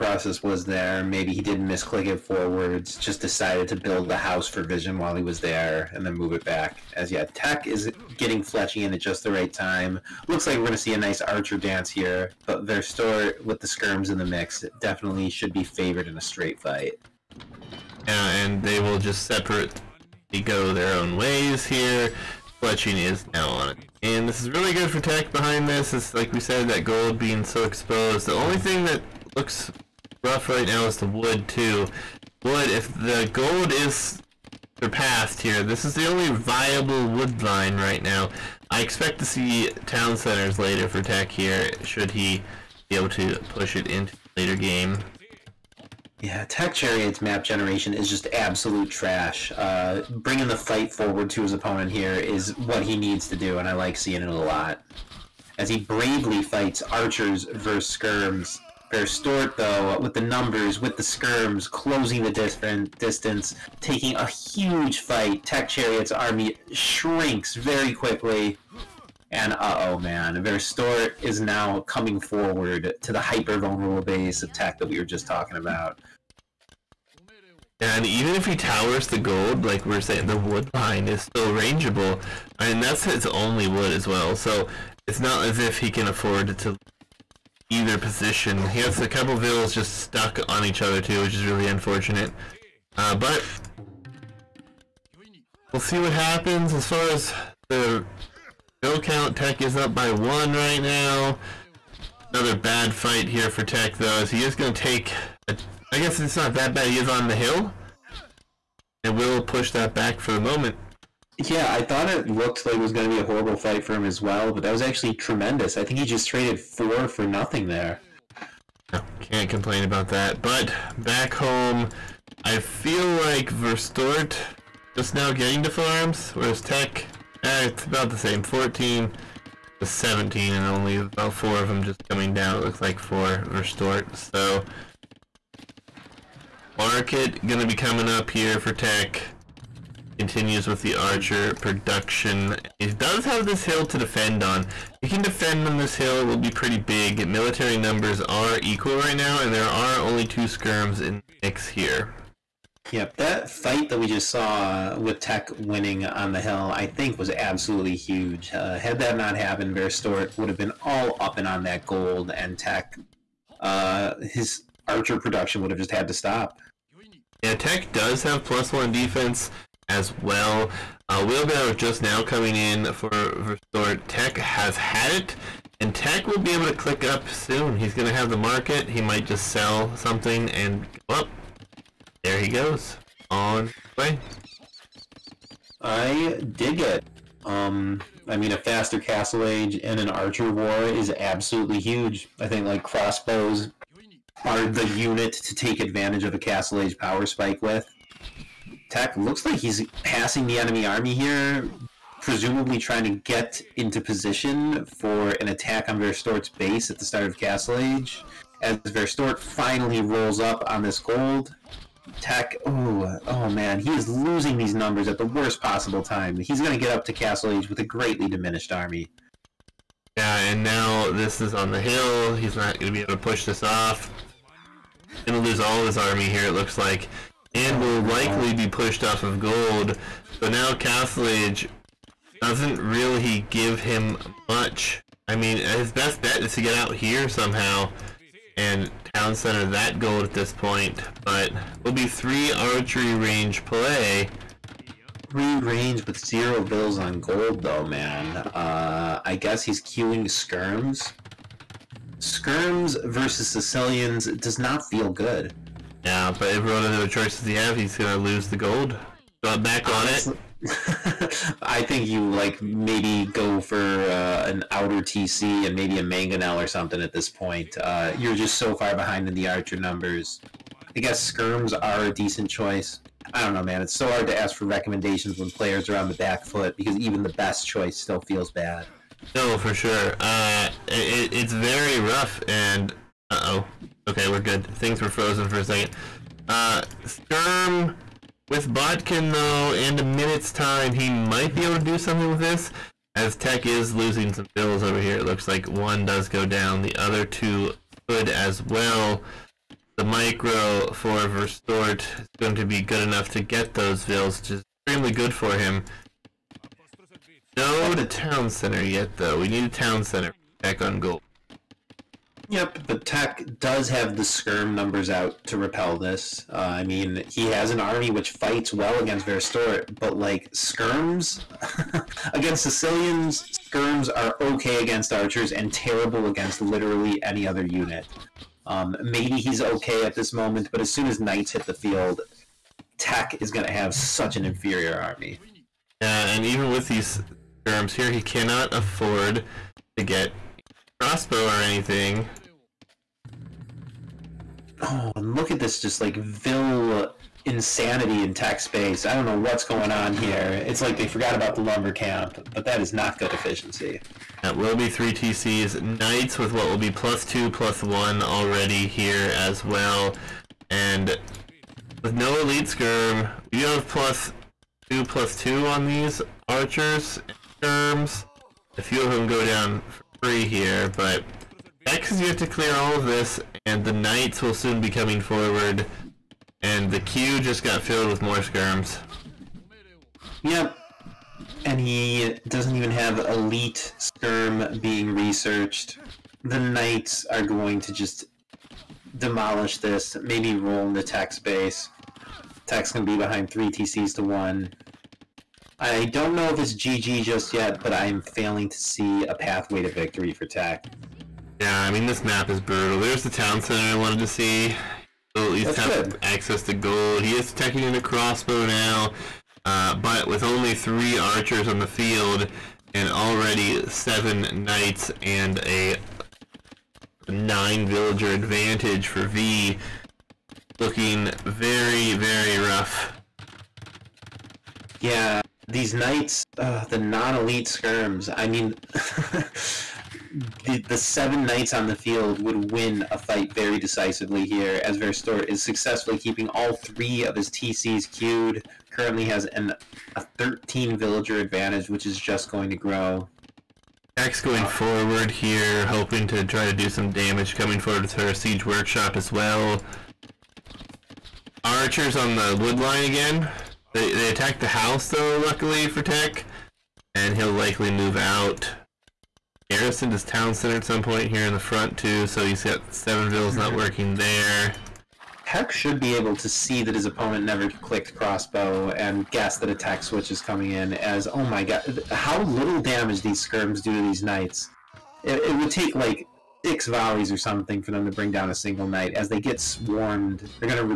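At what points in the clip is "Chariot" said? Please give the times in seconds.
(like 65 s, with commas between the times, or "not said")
46 s, 65 s.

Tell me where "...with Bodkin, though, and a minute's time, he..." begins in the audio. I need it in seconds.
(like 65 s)
288 s.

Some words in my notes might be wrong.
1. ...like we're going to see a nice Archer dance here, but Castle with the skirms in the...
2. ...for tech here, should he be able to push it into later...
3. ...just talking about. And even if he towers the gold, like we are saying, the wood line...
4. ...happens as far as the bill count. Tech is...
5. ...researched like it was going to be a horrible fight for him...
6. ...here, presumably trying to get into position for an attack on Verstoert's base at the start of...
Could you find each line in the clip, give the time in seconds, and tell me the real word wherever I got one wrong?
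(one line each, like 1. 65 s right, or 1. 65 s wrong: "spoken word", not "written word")
1. 10 s wrong: "Verstoert", not "Castle"
2. 40 s right
3. 75 s right
4. 96 s right
5. 112 s wrong: "looked", not "researched"
6. 201 s right.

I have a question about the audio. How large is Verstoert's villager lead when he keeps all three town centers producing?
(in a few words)
13.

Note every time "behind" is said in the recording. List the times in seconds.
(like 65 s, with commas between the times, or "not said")
25 s, 268 s, 393 s.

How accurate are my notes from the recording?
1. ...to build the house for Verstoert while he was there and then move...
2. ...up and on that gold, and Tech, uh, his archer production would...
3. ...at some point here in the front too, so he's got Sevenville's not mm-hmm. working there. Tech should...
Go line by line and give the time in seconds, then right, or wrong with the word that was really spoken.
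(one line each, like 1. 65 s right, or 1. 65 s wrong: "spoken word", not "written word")
1. 3 s wrong: "Vision", not "Verstoert"
2. 161 s right
3. 460 s right.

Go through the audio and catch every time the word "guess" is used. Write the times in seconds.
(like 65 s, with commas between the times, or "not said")
105 s, 249 s, 271 s, 469 s.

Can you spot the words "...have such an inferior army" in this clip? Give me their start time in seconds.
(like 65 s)
333 s.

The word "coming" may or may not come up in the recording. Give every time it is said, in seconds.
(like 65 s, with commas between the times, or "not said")
71 s, 132 s, 137 s, 172 s, 374 s, 447 s, 470 s.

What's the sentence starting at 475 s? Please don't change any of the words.
It, it would take like six volleys or something for them to bring down a single knight as they get swarmed.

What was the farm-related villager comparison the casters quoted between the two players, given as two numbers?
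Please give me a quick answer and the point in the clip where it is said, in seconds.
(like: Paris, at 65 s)
14 to 17, at 128 s.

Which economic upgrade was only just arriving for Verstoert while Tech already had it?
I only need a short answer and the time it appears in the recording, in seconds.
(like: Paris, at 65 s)
Wheelbarrow, at 171 s.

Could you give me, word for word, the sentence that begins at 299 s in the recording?
The micro for Verstoert is going to be good enough to get those bills, which is extremely good for him.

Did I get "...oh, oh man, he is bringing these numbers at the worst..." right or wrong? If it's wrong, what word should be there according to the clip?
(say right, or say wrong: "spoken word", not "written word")
wrong: "losing", not "bringing".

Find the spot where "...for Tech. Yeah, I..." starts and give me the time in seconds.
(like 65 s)
400 s.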